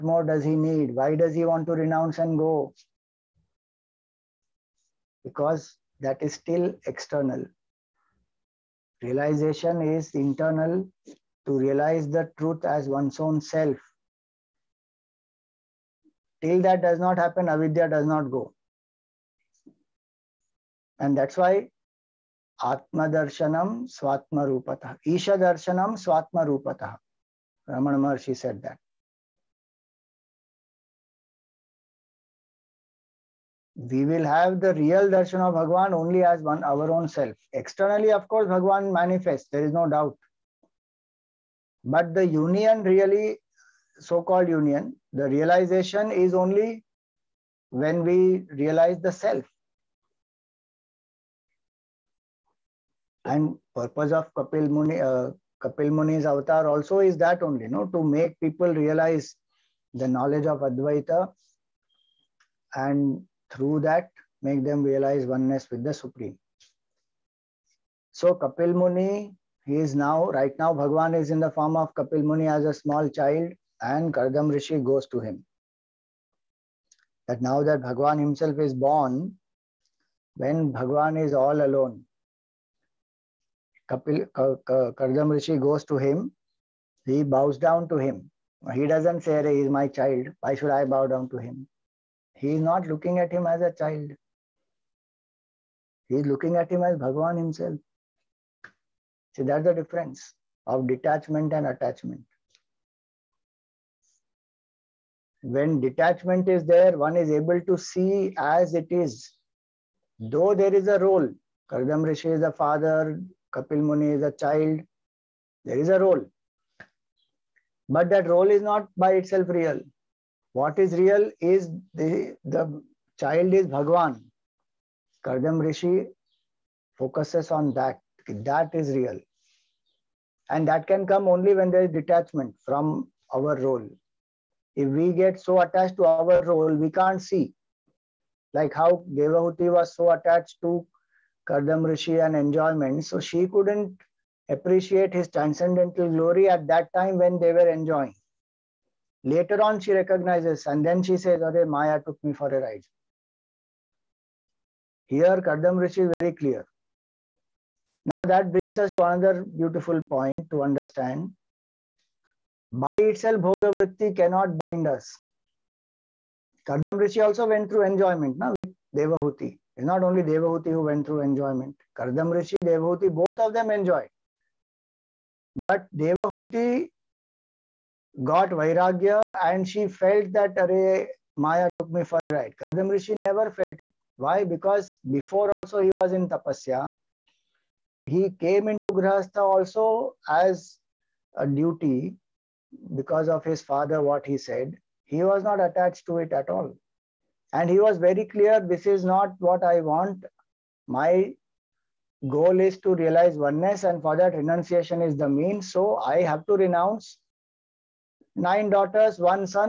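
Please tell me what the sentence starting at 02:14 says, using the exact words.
If we get so attached to our role, we can't see.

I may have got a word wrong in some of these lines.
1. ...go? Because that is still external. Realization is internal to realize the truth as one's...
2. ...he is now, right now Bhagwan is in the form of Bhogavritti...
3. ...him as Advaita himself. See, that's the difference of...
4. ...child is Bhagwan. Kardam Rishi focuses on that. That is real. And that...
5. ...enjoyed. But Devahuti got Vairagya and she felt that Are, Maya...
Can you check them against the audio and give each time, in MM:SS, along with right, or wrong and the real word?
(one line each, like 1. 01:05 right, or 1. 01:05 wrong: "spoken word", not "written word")
1. 00:02 right
2. 01:09 wrong: "Kapil", not "Bhogavritti"
3. 01:36 wrong: "Bhagavan", not "Advaita"
4. 02:03 right
5. 02:53 right.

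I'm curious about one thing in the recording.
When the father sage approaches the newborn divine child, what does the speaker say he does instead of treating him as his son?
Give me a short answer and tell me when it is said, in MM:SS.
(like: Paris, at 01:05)
He bows down to him, at 01:27.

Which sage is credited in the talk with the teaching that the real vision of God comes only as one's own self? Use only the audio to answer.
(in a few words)
Ramana Maharshi.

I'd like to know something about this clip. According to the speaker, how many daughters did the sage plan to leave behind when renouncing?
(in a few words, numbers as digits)
9.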